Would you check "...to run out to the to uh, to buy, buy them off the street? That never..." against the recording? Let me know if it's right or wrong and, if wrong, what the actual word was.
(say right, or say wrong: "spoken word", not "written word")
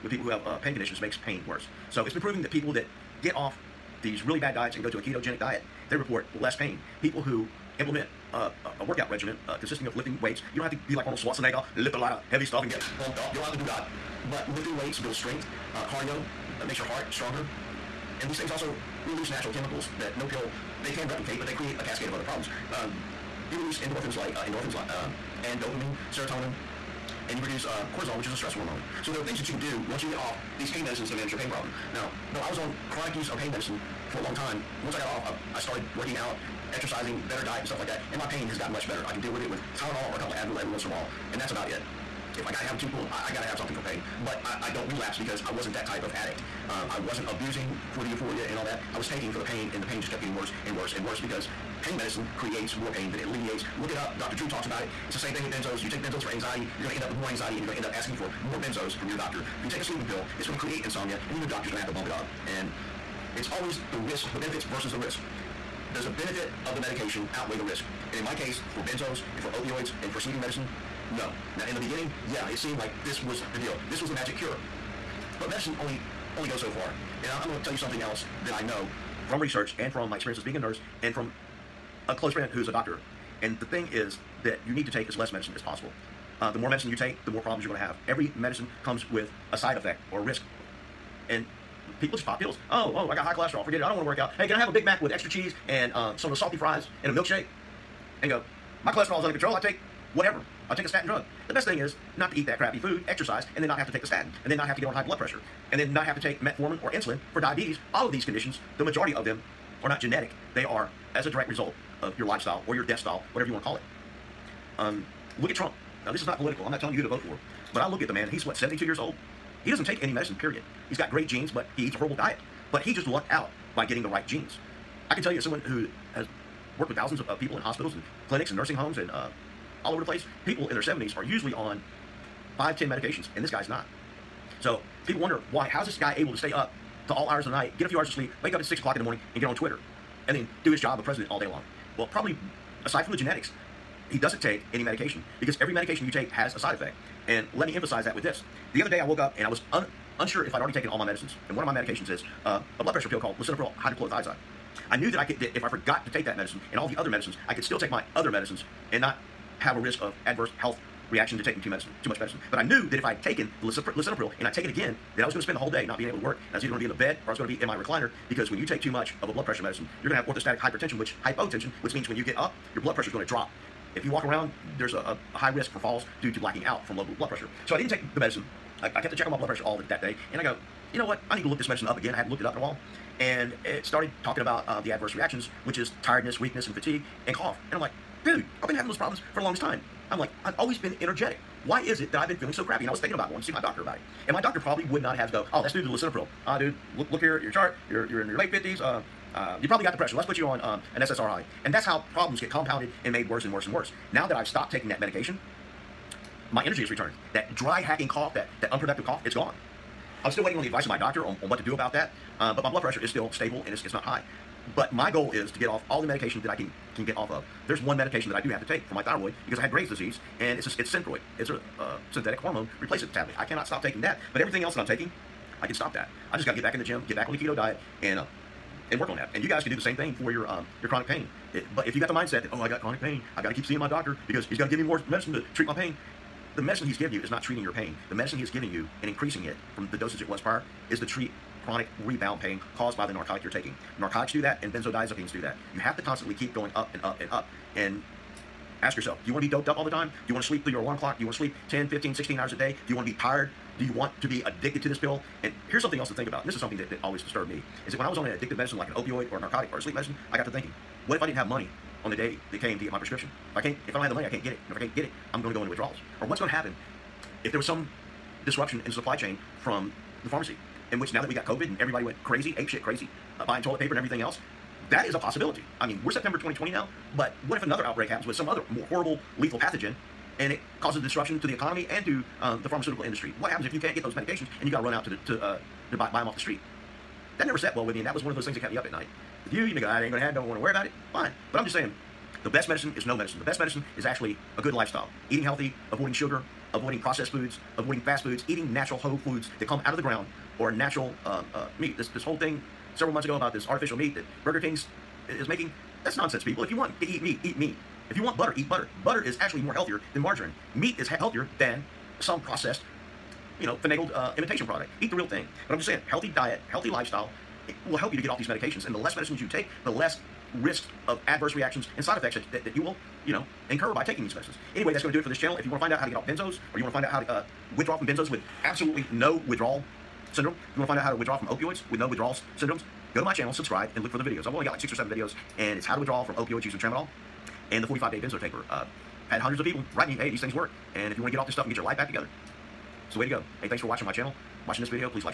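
right.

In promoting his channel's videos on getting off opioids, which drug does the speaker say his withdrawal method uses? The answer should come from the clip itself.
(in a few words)
Tramadol.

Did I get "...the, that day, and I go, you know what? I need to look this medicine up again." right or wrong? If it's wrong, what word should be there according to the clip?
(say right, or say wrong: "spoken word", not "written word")
right.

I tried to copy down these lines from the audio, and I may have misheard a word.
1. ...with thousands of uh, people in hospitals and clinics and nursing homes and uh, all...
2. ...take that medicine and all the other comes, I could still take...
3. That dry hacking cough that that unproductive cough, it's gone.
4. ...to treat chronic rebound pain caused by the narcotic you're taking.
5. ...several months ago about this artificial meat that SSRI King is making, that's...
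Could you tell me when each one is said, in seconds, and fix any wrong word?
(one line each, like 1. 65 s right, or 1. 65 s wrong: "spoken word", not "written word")
1. 126 s right
2. 156 s wrong: "medicines", not "comes"
3. 207 s right
4. 240 s right
5. 302 s wrong: "Burger", not "SSRI".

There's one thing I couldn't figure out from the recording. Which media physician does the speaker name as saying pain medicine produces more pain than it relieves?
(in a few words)
Dr. Drew.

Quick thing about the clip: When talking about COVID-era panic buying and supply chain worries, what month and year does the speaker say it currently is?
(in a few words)
September 2020.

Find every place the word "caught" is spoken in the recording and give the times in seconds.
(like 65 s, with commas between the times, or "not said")
not said.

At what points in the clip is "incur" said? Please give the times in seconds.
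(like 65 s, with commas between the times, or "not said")
323 s.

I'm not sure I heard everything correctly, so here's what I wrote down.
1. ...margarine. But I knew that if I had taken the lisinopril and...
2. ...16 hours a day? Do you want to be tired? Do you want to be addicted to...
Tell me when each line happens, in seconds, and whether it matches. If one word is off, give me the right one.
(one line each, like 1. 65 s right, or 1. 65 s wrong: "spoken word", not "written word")
1. 162 s wrong: "medicine", not "margarine"
2. 252 s right.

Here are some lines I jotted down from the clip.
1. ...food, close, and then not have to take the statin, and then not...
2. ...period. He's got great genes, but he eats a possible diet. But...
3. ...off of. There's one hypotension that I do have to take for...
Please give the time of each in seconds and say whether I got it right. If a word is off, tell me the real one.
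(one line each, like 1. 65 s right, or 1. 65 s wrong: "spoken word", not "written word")
1. 102 s wrong: "exercise", not "close"
2. 120 s wrong: "horrible", not "possible"
3. 217 s wrong: "medication", not "hypotension".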